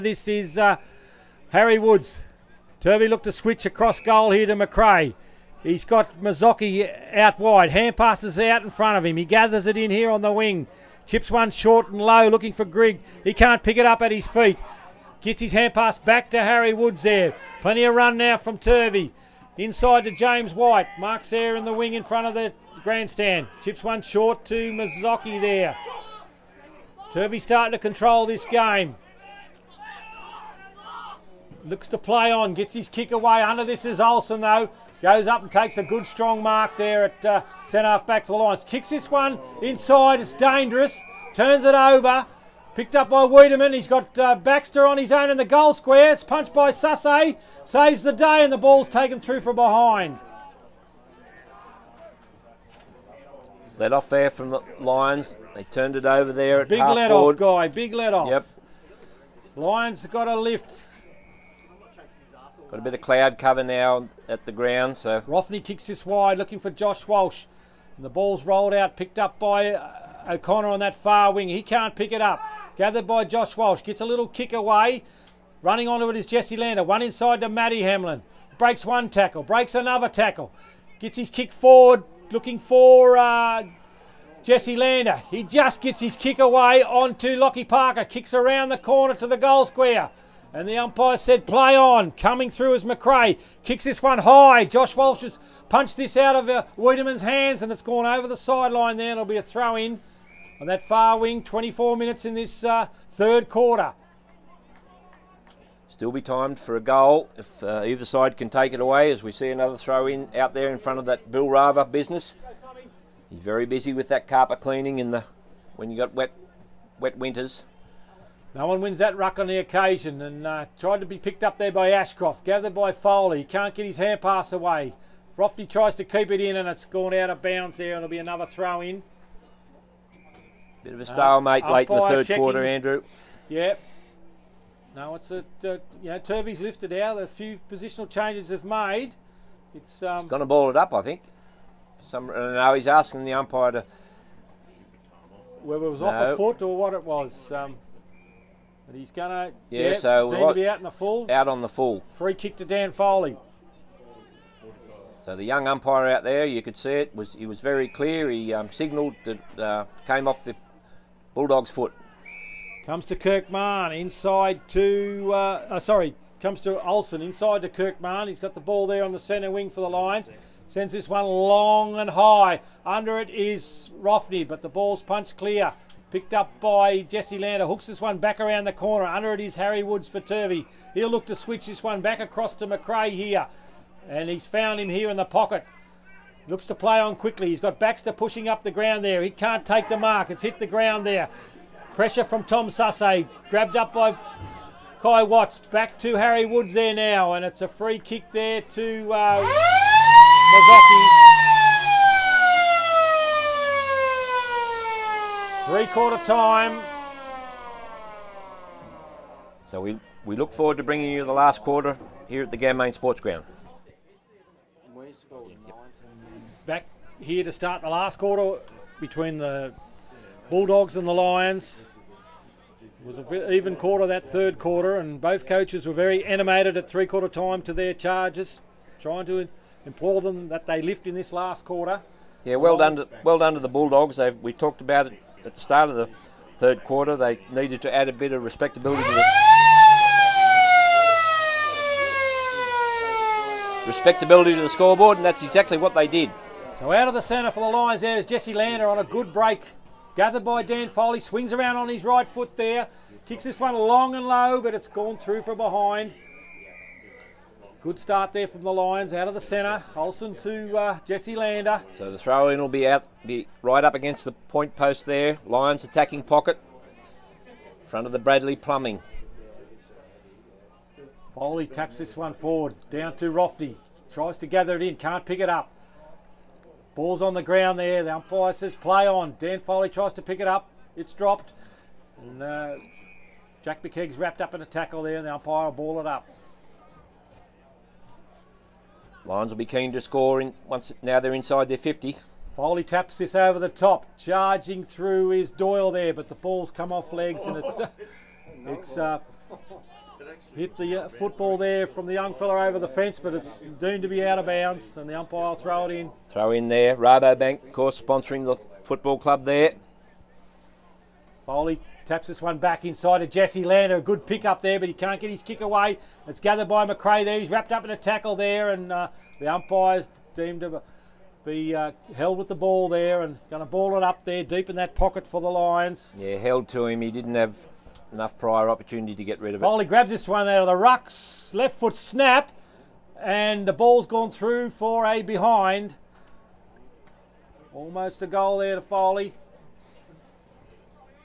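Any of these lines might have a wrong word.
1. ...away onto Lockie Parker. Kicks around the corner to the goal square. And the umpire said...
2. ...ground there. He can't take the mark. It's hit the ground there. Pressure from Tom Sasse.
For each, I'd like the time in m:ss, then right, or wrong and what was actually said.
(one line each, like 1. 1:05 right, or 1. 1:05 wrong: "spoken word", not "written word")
1. 1:26 right
2. 3:08 right.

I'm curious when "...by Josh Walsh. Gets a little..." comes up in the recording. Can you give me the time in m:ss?
1:13.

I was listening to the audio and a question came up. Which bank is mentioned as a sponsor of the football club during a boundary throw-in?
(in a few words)
Rabobank.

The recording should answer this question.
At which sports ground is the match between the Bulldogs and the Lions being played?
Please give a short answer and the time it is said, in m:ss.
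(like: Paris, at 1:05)
Ganmain Sports Ground, at 3:32.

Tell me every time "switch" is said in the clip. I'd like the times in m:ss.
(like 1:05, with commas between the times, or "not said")
0:03, 3:01.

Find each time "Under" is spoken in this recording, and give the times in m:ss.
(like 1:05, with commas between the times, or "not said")
0:33, 2:52, 2:59.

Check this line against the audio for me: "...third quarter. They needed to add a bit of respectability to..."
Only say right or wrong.
right.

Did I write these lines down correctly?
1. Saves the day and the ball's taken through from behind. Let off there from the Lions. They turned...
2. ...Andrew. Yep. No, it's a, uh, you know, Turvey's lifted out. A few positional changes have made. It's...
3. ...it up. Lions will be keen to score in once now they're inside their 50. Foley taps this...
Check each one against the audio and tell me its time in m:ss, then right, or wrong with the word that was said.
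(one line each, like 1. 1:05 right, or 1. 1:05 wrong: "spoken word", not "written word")
1. 0:47 right
2. 2:12 right
3. 4:46 right.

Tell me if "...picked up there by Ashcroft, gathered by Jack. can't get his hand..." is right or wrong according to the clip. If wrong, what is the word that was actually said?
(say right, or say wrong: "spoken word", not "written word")
wrong: "Foley", not "Jack".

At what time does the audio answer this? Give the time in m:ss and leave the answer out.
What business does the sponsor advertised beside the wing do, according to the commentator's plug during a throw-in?
1:54.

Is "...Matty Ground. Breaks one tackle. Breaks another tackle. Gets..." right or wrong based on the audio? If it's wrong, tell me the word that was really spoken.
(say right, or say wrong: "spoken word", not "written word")
wrong: "Hamlin", not "Ground".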